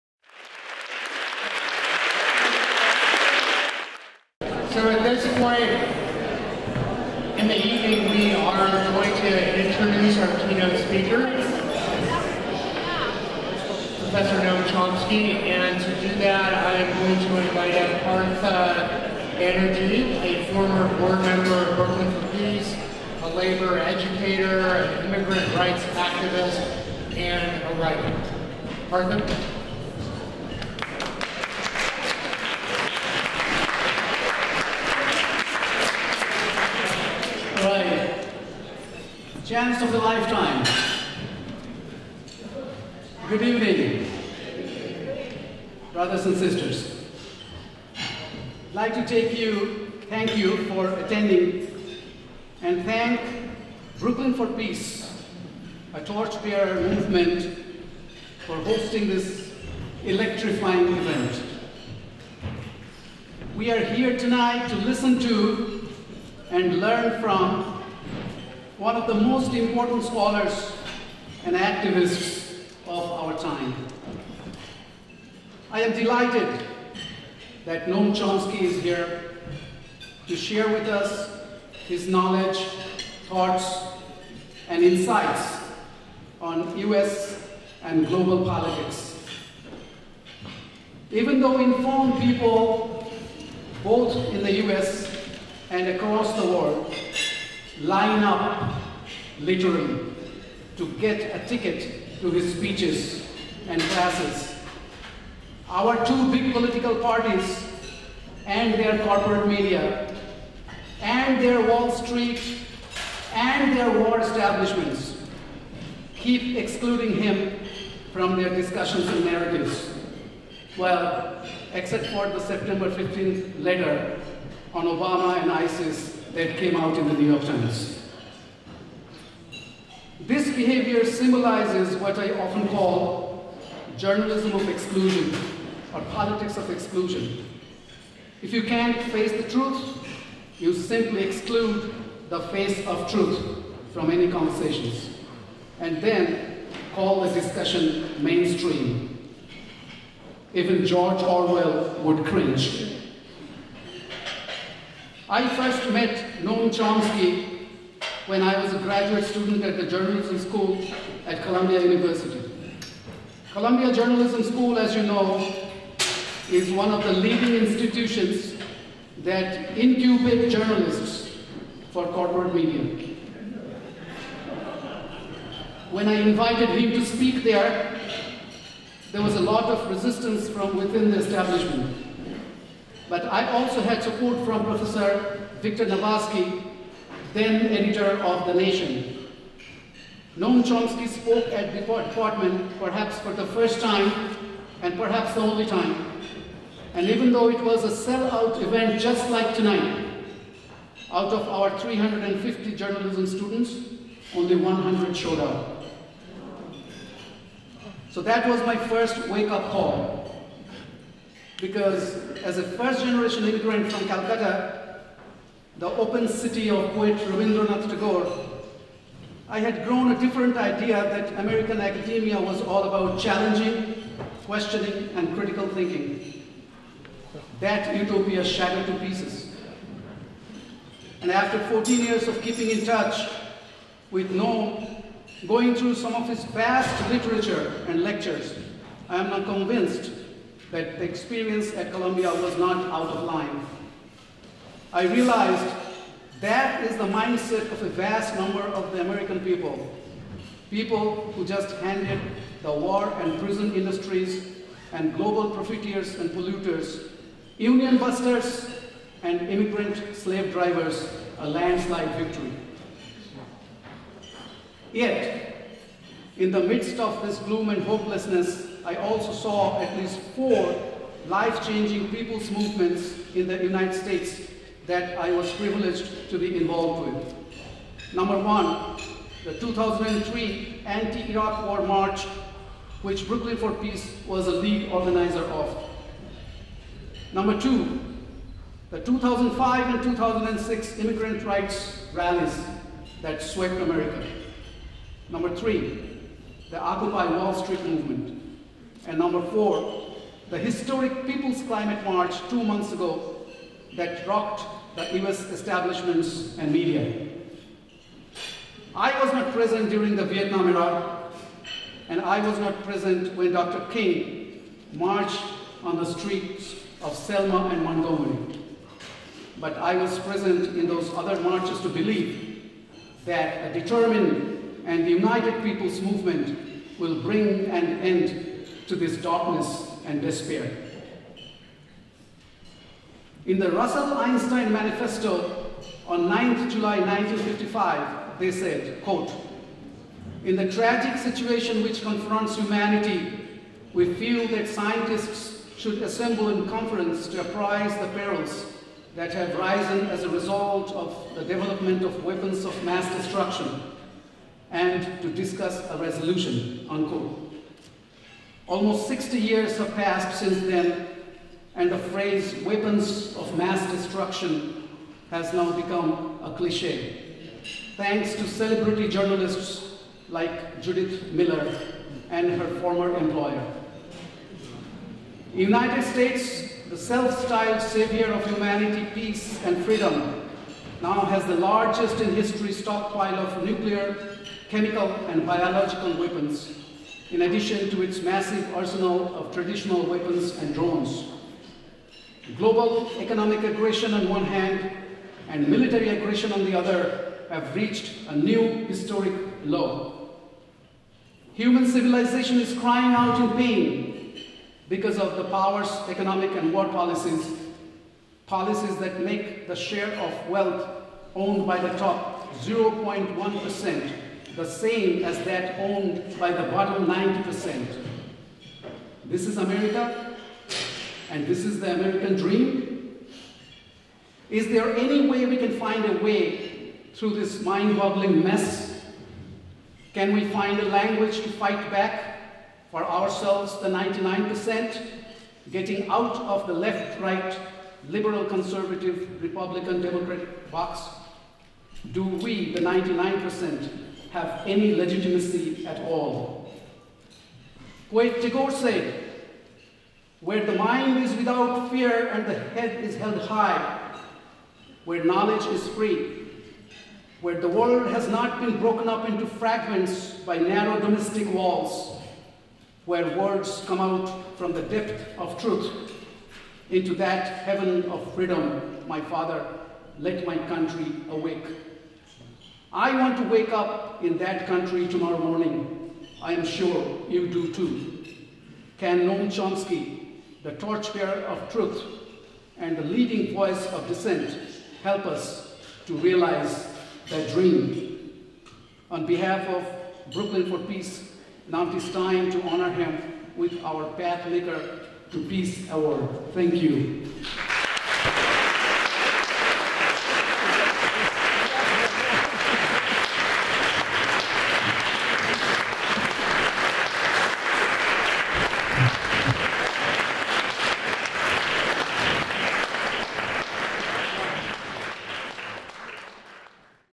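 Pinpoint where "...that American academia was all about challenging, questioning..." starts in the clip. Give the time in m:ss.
3:41.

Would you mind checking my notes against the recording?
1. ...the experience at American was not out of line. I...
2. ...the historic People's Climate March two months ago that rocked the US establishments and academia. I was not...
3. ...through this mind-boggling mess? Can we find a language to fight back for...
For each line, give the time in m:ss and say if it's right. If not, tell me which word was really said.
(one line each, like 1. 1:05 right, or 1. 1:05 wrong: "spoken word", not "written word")
1. 4:00 wrong: "Columbia", not "American"
2. 5:00 wrong: "media", not "academia"
3. 7:07 right.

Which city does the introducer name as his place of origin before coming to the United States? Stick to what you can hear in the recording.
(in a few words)
Calcutta.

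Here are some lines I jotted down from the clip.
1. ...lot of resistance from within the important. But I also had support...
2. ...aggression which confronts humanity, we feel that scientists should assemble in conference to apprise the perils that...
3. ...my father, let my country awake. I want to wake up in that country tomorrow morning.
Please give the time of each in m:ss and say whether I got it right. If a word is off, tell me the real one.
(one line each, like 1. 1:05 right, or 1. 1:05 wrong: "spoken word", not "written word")
1. 2:59 wrong: "establishment", not "important"
2. 5:41 wrong: "situation", not "aggression"
3. 7:49 right.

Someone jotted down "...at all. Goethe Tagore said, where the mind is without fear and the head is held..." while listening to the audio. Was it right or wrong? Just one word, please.
right.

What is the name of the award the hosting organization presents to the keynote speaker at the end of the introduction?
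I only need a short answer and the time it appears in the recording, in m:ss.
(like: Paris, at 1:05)
Pathmaker to Peace Award, at 8:14.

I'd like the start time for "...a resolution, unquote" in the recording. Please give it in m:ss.
5:55.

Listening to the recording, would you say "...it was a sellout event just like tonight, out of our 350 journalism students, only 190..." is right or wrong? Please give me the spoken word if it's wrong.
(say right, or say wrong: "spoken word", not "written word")
wrong: "100", not "190".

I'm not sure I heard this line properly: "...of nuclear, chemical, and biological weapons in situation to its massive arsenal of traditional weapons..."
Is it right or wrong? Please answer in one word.
wrong.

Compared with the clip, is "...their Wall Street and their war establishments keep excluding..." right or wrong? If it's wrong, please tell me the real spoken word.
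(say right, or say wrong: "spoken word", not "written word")
right.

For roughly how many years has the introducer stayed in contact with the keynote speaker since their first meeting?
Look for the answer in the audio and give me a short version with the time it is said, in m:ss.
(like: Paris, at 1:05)
14, at 3:51.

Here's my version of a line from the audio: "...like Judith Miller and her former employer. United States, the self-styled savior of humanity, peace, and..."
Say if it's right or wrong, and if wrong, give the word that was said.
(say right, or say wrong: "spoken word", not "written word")
right.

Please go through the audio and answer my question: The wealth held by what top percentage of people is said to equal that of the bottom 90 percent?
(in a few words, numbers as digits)
0.1%.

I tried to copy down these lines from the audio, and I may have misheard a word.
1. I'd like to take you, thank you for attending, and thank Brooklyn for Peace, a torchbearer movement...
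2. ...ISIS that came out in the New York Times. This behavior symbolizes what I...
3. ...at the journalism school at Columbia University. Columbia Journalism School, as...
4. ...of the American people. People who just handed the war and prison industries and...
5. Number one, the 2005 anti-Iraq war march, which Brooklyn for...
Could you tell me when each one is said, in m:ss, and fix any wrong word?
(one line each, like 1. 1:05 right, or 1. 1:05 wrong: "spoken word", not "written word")
1. 0:47 right
2. 2:05 right
3. 2:39 right
4. 4:08 right
5. 4:38 wrong: "2003", not "2005".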